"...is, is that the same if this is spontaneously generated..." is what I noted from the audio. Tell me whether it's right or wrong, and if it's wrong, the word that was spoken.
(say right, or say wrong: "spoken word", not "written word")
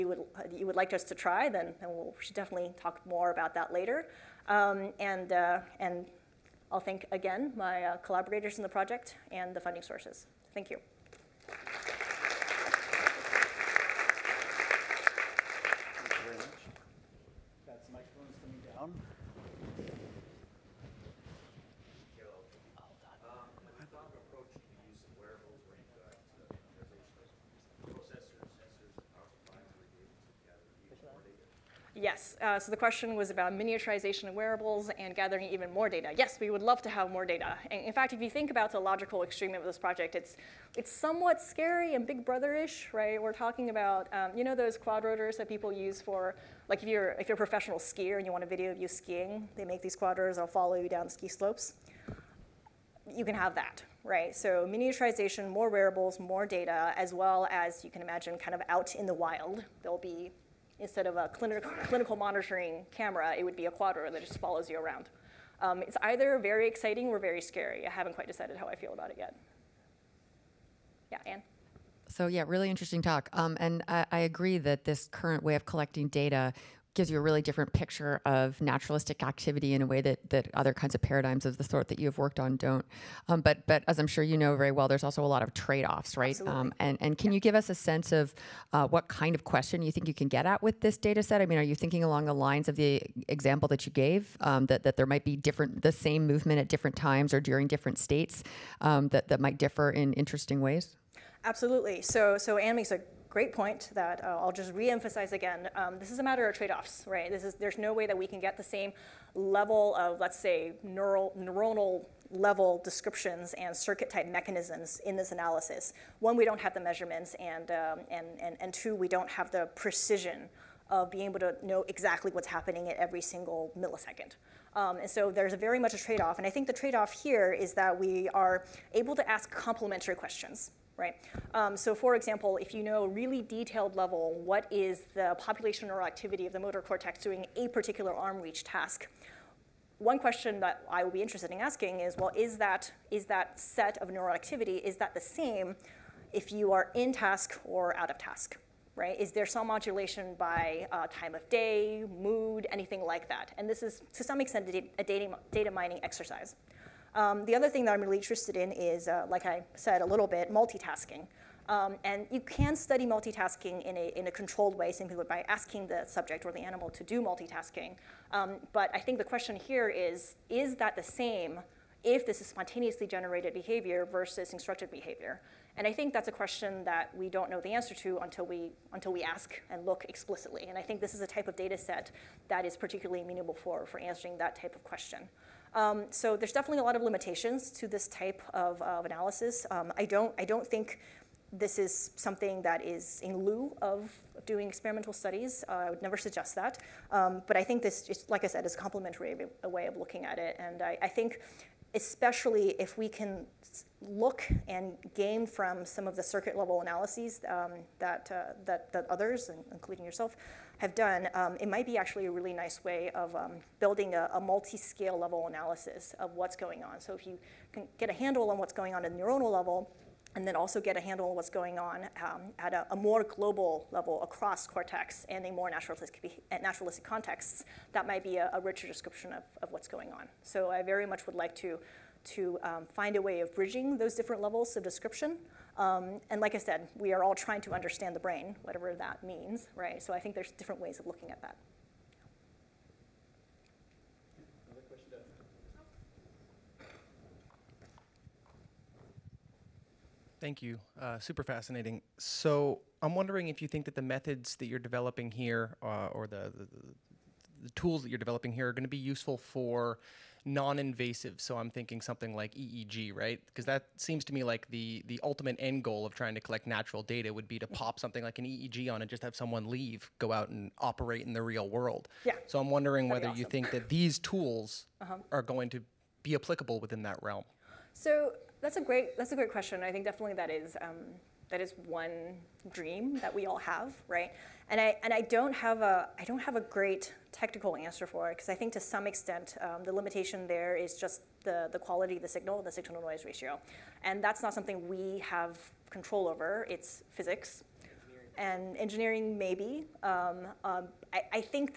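right.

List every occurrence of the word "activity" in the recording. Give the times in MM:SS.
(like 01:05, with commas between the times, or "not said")
01:19, 02:16, 02:24.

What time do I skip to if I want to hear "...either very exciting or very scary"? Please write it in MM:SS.
01:06.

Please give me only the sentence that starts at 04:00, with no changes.
So I think there's different ways of looking at that.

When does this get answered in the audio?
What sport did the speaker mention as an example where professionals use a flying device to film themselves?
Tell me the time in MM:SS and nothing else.
00:48.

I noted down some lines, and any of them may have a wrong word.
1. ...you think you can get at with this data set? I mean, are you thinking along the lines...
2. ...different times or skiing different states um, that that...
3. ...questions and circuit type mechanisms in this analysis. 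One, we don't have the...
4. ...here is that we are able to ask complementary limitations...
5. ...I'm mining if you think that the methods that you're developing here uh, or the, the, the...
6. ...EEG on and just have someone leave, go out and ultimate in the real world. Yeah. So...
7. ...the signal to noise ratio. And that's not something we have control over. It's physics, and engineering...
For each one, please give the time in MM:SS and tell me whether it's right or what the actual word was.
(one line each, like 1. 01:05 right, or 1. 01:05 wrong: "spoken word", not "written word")
1. 01:29 right
2. 01:36 wrong: "during", not "skiing"
3. 01:52 wrong: "descriptions", not "questions"
4. 02:07 wrong: "questions", not "limitations"
5. 04:12 wrong: "wondering", not "mining"
6. 04:28 wrong: "operate", not "ultimate"
7. 04:52 right.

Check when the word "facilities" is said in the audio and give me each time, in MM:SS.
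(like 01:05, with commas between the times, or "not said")
not said.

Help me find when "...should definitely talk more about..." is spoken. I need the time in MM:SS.
00:02.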